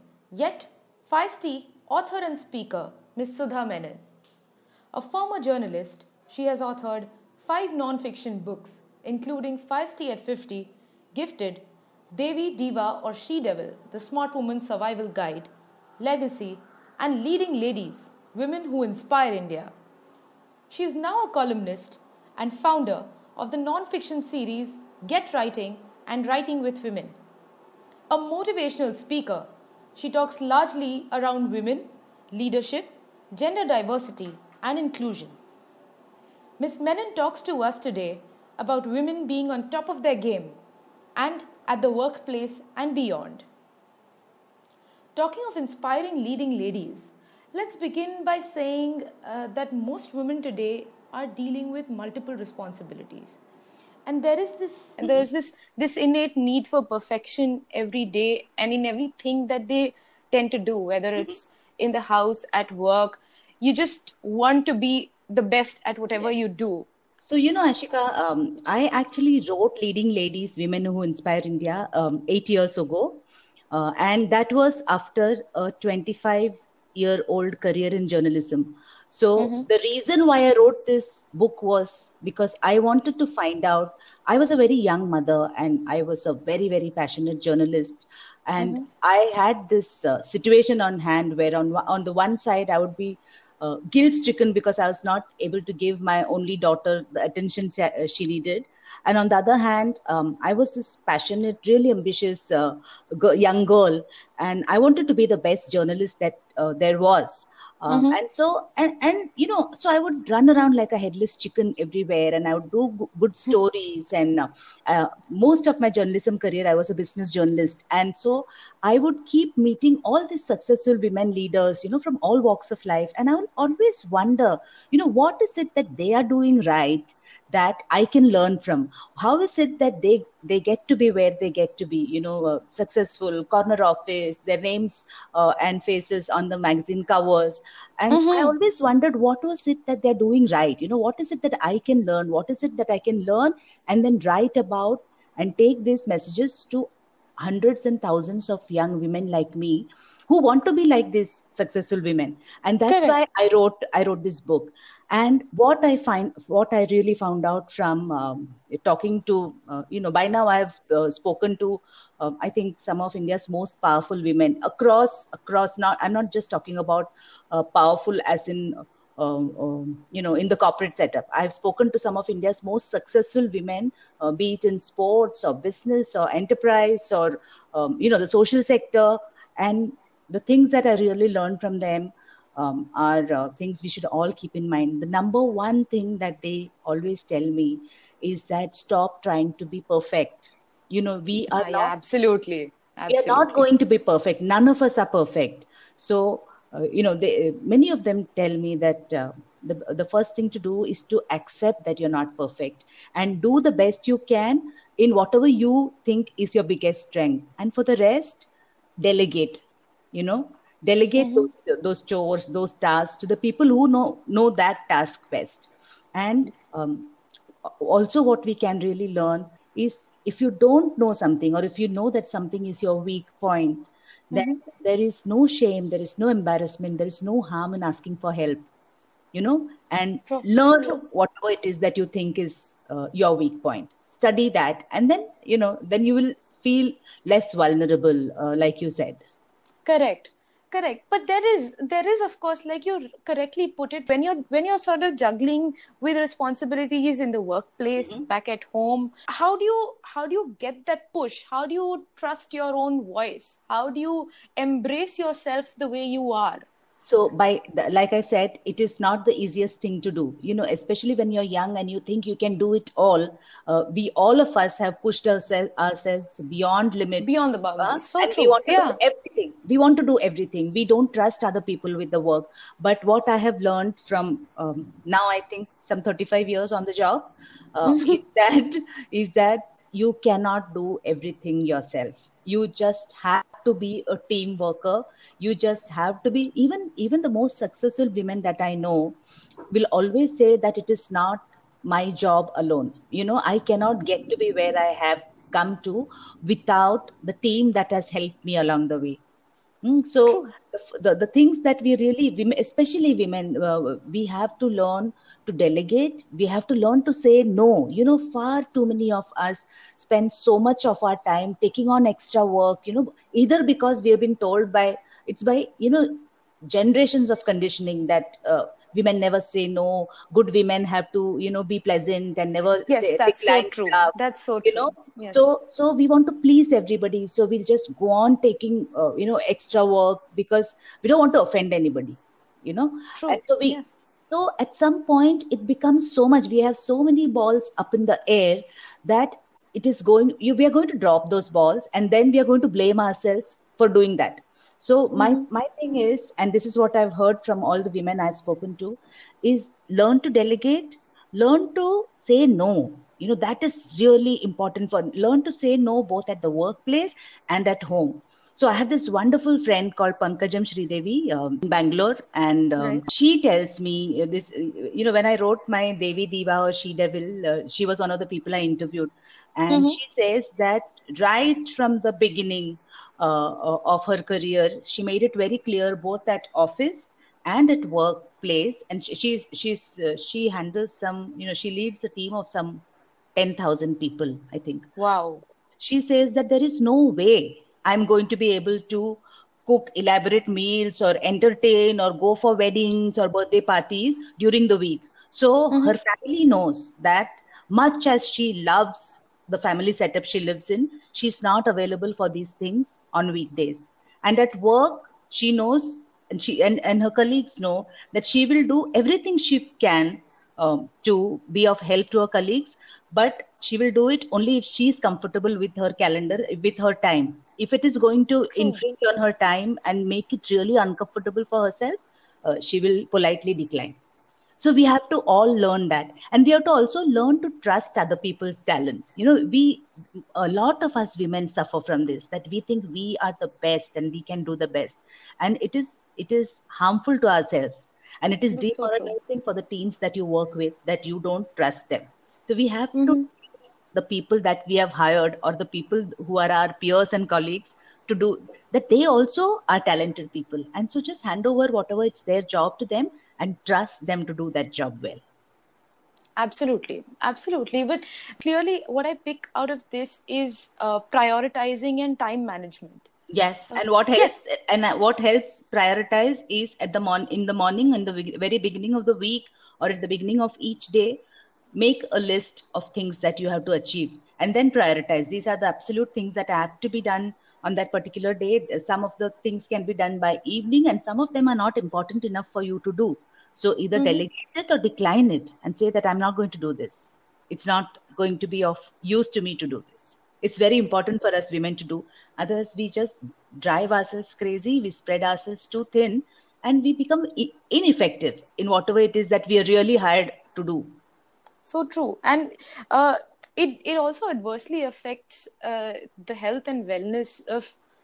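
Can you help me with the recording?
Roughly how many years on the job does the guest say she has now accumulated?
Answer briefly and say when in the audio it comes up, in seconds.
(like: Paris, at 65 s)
35 years, at 276 s.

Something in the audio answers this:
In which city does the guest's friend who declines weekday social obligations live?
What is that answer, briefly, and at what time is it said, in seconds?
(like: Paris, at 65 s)
Bangalore, at 361 s.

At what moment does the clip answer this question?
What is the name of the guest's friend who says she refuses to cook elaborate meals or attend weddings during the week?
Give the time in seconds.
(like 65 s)
360 s.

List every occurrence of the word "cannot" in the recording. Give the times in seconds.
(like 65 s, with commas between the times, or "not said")
280 s, 293 s.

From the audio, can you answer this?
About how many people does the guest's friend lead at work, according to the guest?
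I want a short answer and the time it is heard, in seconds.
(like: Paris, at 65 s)
10,000, at 383 s.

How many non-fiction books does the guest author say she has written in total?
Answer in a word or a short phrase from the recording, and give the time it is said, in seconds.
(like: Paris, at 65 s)
5, at 7 s.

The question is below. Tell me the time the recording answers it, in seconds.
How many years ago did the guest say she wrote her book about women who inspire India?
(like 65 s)
72 s.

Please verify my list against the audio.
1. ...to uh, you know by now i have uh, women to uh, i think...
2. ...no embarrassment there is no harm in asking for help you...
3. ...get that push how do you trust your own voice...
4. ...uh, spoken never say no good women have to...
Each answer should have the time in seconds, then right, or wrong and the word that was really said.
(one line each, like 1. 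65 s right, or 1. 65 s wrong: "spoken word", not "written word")
1. 159 s wrong: "spoken", not "women"
2. 226 s right
3. 250 s right
4. 318 s wrong: "women", not "spoken".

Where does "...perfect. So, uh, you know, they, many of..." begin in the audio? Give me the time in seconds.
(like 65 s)
195 s.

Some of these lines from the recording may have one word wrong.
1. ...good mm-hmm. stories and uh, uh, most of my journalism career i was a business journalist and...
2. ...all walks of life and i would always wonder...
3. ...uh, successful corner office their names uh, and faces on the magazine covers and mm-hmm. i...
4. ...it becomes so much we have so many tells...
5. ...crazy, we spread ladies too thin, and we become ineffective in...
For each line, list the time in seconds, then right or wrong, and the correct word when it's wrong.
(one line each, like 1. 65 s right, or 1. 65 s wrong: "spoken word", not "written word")
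1. 113 s right
2. 122 s right
3. 132 s right
4. 335 s wrong: "balls", not "tells"
5. 494 s wrong: "ourselves", not "ladies".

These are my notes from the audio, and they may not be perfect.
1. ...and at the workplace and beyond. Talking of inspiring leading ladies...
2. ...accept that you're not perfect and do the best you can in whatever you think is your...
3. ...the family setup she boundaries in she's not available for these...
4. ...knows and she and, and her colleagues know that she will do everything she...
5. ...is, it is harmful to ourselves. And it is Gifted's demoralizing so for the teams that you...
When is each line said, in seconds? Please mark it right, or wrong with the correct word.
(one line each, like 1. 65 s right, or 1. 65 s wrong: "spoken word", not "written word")
1. 41 s right
2. 201 s right
3. 399 s wrong: "lives", not "boundaries"
4. 405 s right
5. 435 s wrong: "That", not "Gifted".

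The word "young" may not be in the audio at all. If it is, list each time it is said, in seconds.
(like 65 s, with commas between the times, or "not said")
84 s, 103 s, 148 s, 261 s.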